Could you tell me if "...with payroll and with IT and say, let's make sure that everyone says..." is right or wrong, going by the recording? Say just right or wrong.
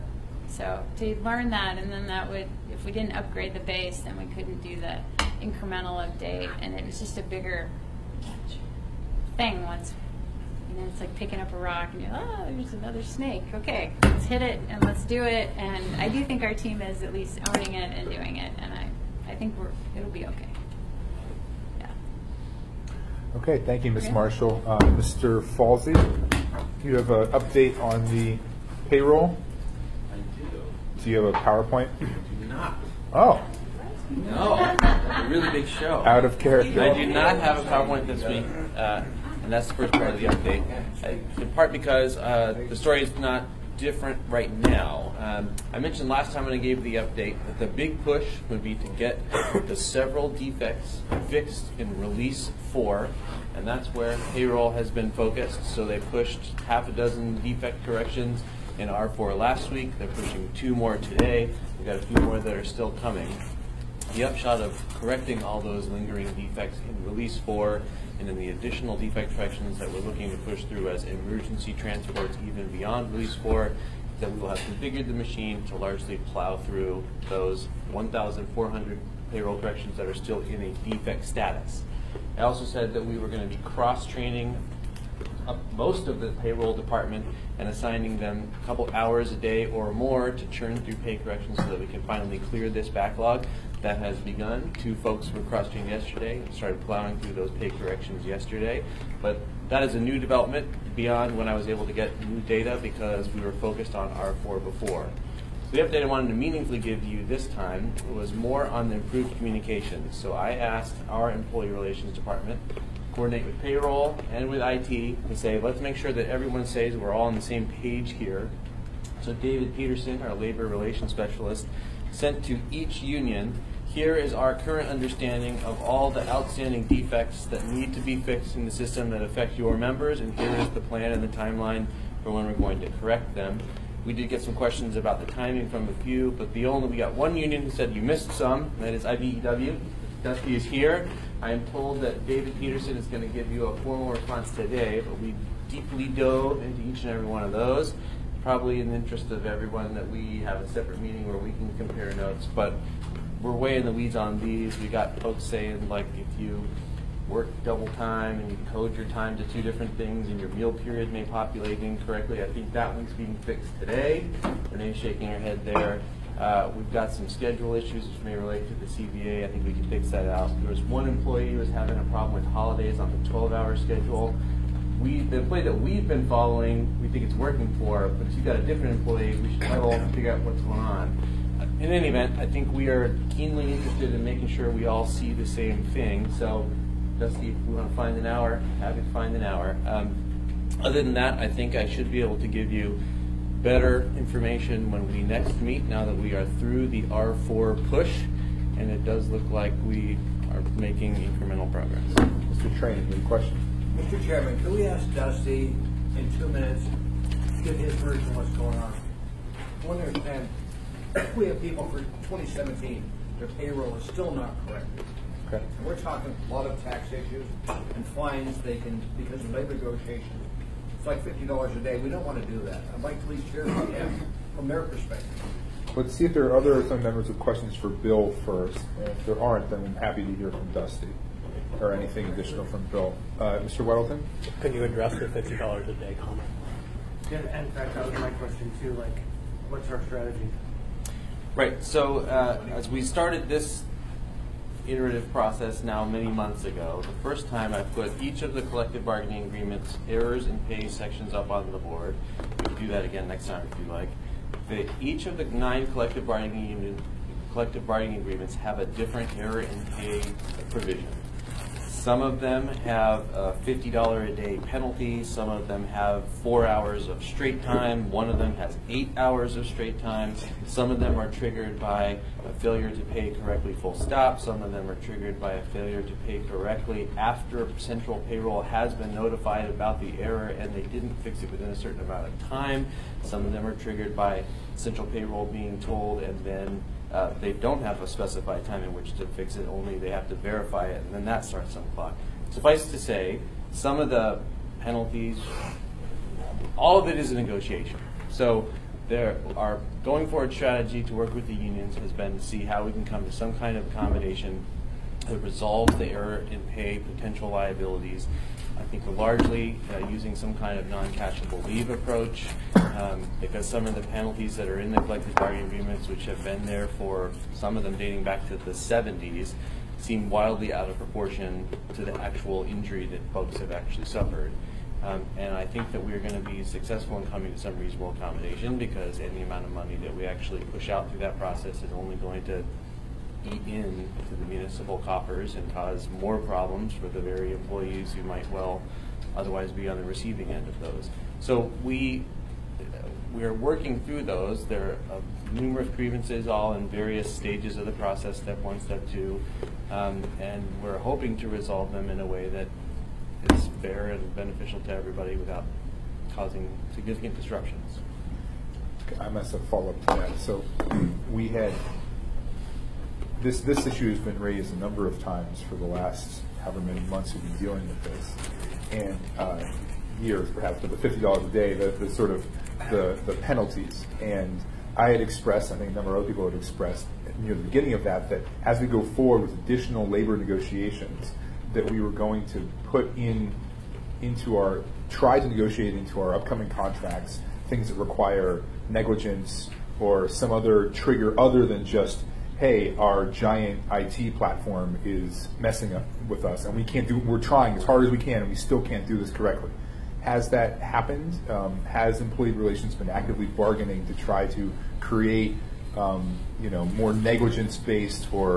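right.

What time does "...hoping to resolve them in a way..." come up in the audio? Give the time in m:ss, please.
5:50.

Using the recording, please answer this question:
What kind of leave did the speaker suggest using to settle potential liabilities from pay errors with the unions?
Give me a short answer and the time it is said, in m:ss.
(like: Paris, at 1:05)
non-cashable leave, at 5:10.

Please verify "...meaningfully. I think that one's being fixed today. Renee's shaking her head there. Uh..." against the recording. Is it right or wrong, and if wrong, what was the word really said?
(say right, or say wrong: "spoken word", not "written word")
wrong: "incorrectly", not "meaningfully".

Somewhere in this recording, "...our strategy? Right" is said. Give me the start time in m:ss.
3:59.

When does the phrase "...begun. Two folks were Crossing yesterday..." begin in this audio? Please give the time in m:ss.
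1:34.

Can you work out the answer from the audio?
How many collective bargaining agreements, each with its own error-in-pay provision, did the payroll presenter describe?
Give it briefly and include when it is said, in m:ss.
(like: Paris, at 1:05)
9, at 4:15.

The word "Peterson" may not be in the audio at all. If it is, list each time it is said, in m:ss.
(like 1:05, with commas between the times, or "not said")
1:59, 2:22.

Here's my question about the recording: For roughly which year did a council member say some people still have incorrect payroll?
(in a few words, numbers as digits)
2017.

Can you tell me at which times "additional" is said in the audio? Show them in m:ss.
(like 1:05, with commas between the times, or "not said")
1:08, 3:52, 6:19.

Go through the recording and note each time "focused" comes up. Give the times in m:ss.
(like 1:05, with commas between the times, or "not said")
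0:55, 1:43.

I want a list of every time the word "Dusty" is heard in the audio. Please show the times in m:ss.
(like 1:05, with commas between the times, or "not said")
2:20, 3:07, 3:25, 3:50.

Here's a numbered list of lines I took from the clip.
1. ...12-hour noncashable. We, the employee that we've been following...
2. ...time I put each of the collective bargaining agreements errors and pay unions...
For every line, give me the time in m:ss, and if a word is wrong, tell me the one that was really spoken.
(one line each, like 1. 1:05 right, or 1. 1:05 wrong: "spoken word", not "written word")
1. 2:53 wrong: "schedule", not "noncashable"
2. 4:07 wrong: "sections", not "unions".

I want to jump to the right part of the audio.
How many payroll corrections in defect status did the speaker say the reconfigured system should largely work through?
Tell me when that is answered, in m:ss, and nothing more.
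1:17.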